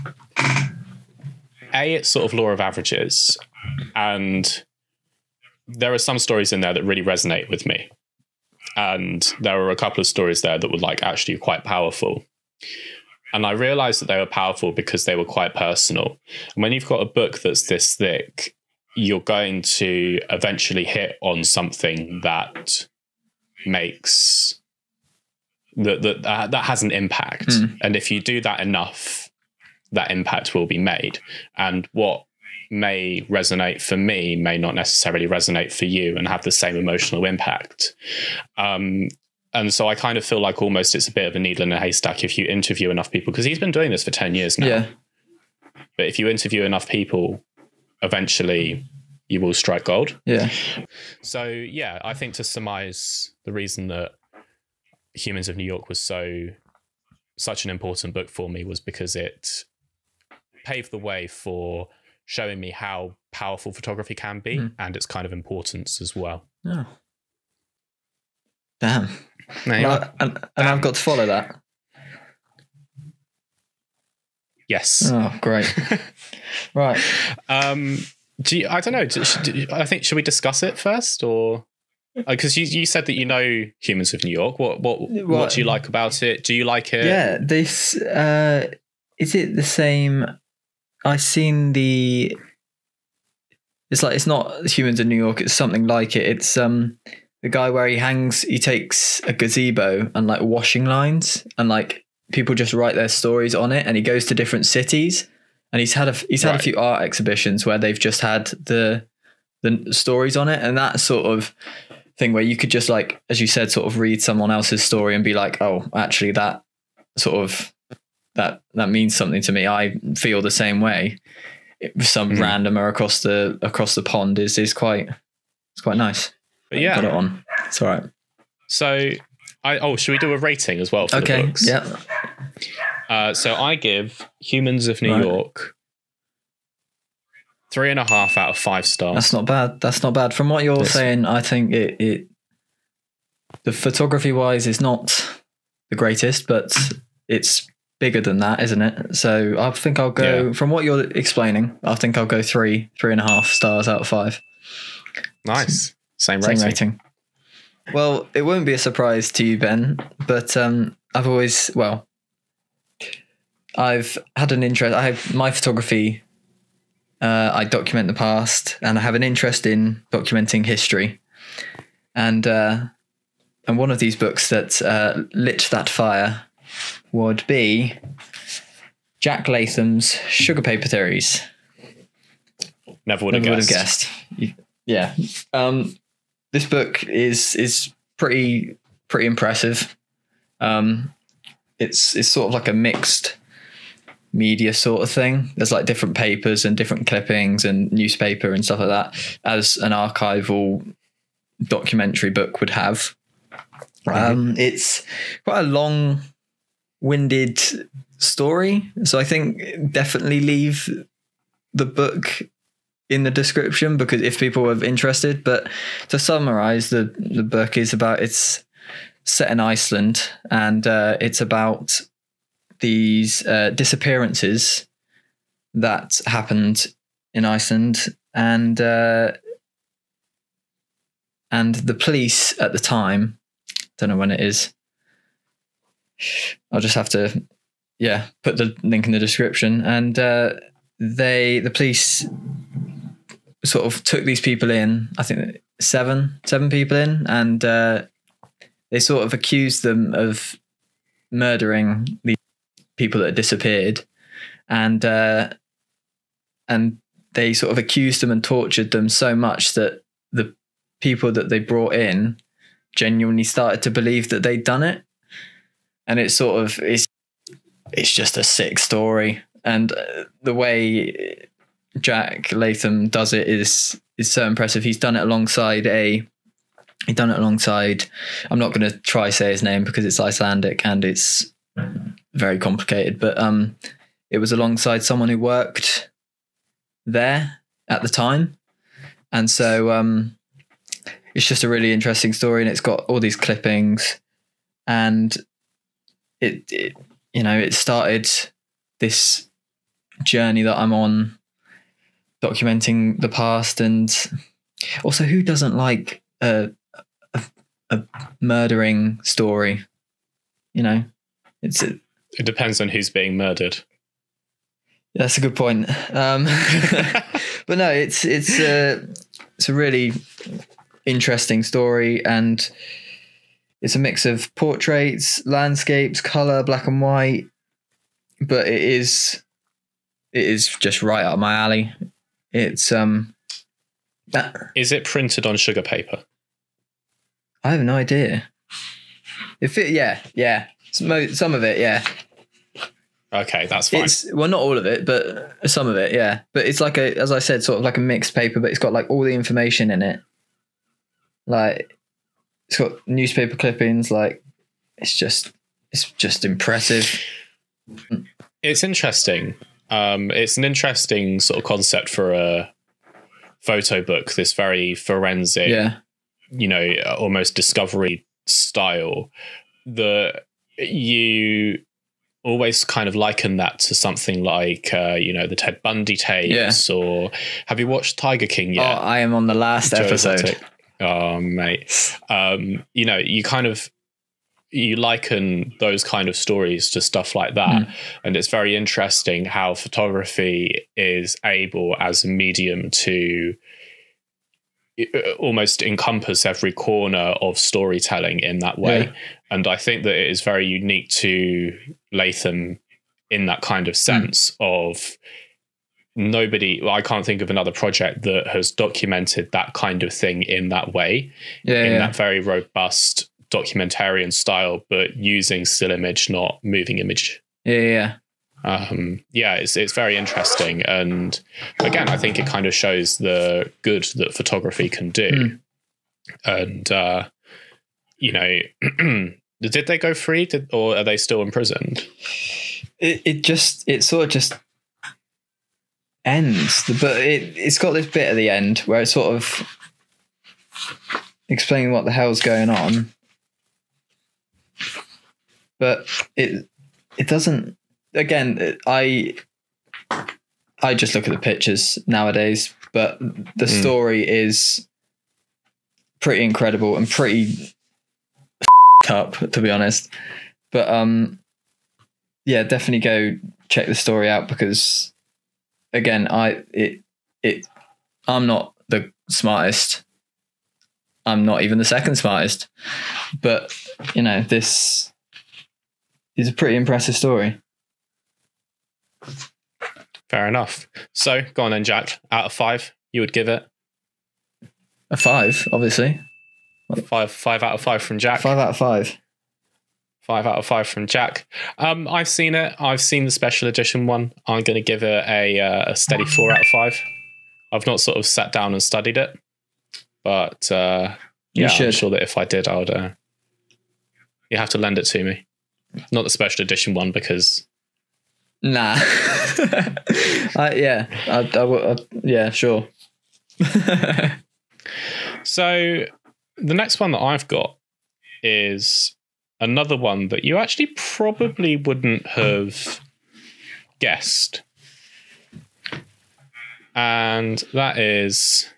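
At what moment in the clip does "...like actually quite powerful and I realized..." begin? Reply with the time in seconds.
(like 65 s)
10 s.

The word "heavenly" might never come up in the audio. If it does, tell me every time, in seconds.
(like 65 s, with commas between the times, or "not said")
not said.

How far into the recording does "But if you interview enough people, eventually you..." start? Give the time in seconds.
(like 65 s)
45 s.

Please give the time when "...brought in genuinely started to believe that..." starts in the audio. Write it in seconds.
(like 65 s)
261 s.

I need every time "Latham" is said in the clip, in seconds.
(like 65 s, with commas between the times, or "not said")
179 s, 272 s, 402 s.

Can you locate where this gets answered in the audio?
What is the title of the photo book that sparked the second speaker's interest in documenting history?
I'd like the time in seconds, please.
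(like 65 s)
180 s.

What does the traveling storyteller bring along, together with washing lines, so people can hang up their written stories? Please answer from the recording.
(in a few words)
A gazebo.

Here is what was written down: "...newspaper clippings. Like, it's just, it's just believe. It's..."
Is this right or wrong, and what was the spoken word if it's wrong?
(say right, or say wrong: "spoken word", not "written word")
wrong: "impressive", not "believe".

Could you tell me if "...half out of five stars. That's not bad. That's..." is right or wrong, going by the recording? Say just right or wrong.
right.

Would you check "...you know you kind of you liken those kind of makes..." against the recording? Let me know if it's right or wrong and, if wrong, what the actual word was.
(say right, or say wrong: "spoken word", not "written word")
wrong: "stories", not "makes".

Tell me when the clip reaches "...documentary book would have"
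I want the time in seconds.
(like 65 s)
201 s.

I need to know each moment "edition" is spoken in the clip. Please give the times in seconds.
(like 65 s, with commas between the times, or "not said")
493 s, 506 s.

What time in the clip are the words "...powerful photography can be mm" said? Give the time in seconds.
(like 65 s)
63 s.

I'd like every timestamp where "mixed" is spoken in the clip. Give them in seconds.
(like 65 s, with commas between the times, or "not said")
192 s, 348 s.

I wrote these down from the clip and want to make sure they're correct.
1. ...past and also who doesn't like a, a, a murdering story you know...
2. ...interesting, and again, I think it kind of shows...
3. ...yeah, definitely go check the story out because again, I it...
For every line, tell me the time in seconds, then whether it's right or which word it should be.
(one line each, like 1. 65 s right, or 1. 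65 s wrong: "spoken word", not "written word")
1. 303 s right
2. 420 s right
3. 462 s right.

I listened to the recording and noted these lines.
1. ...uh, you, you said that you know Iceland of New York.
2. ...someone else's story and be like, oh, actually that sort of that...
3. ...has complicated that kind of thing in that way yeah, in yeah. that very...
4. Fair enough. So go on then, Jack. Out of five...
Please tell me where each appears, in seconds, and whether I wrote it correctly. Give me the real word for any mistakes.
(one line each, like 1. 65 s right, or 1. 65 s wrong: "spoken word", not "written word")
1. 82 s wrong: "Humans", not "Iceland"
2. 114 s right
3. 408 s wrong: "documented", not "complicated"
4. 480 s right.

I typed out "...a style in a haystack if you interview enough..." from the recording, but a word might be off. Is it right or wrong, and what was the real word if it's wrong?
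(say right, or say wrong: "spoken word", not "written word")
wrong: "needle", not "style".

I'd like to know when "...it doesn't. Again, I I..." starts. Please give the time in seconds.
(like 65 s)
447 s.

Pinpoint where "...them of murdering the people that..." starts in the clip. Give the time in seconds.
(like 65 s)
249 s.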